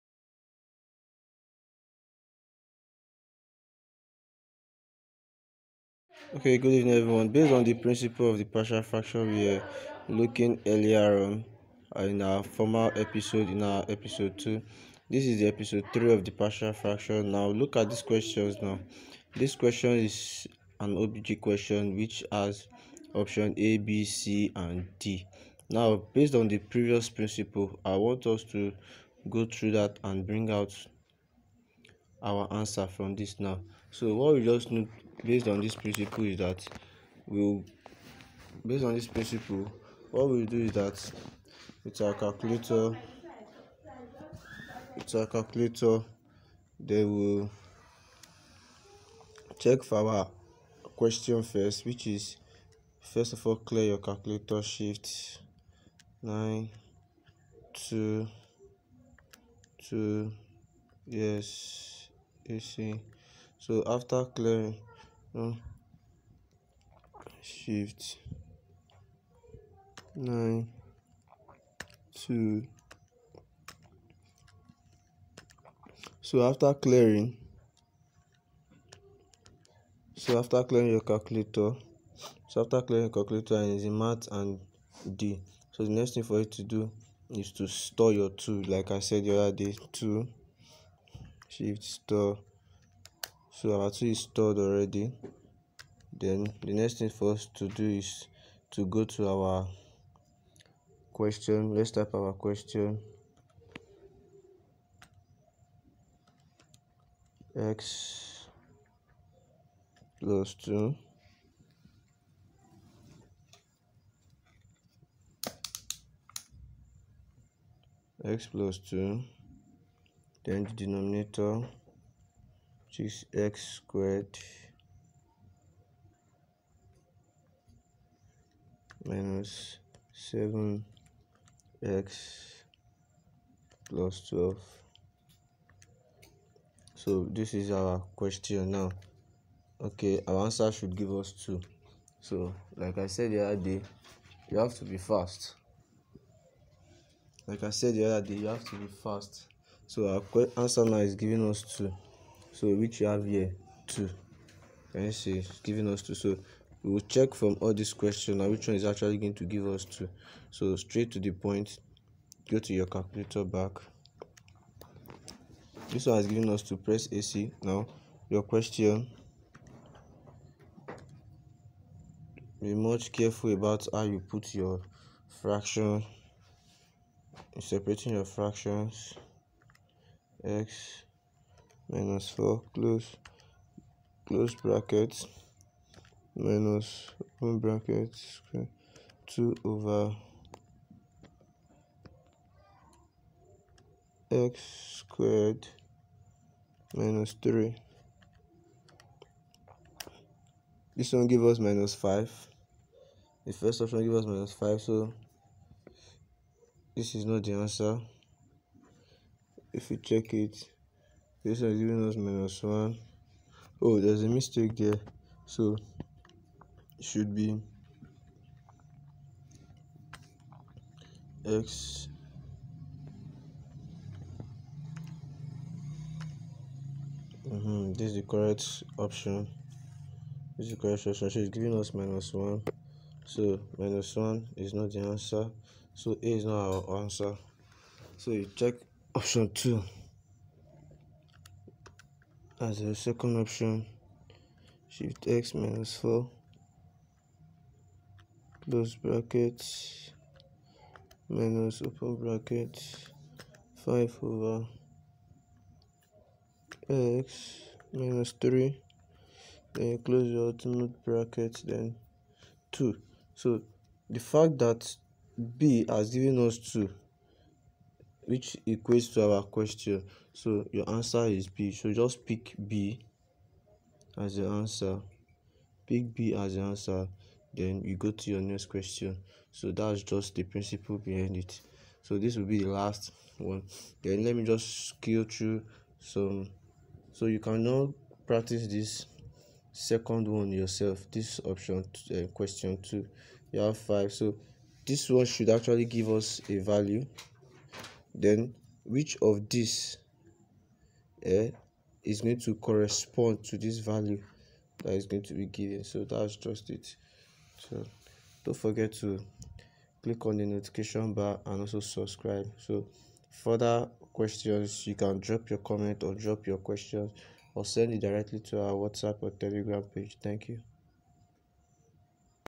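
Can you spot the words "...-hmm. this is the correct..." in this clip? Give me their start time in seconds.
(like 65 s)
227 s.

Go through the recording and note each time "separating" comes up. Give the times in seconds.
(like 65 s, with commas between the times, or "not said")
177 s.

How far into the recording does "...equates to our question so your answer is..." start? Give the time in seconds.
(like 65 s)
268 s.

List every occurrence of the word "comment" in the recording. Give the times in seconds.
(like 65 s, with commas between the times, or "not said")
315 s.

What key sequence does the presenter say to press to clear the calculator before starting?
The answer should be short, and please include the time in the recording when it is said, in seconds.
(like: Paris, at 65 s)
shift 9 2 2, at 54 s.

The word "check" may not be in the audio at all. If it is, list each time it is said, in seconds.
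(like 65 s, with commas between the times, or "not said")
49 s, 157 s, 209 s, 238 s.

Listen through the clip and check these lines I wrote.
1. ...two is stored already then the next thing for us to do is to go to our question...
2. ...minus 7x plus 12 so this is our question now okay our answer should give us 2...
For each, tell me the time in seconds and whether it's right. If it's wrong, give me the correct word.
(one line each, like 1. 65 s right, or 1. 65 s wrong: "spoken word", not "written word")
1. 93 s right
2. 129 s right.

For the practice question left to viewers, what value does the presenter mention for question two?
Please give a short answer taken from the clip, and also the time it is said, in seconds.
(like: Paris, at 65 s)
5, at 293 s.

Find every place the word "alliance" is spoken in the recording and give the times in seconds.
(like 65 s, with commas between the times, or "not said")
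not said.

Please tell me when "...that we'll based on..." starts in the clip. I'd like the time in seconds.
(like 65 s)
36 s.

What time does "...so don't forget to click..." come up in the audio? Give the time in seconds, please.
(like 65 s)
307 s.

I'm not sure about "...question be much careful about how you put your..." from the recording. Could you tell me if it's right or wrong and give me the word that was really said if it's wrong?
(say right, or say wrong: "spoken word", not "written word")
right.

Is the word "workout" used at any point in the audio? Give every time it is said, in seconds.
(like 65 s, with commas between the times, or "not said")
not said.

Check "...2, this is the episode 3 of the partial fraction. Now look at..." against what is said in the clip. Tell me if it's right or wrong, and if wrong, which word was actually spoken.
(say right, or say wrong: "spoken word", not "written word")
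right.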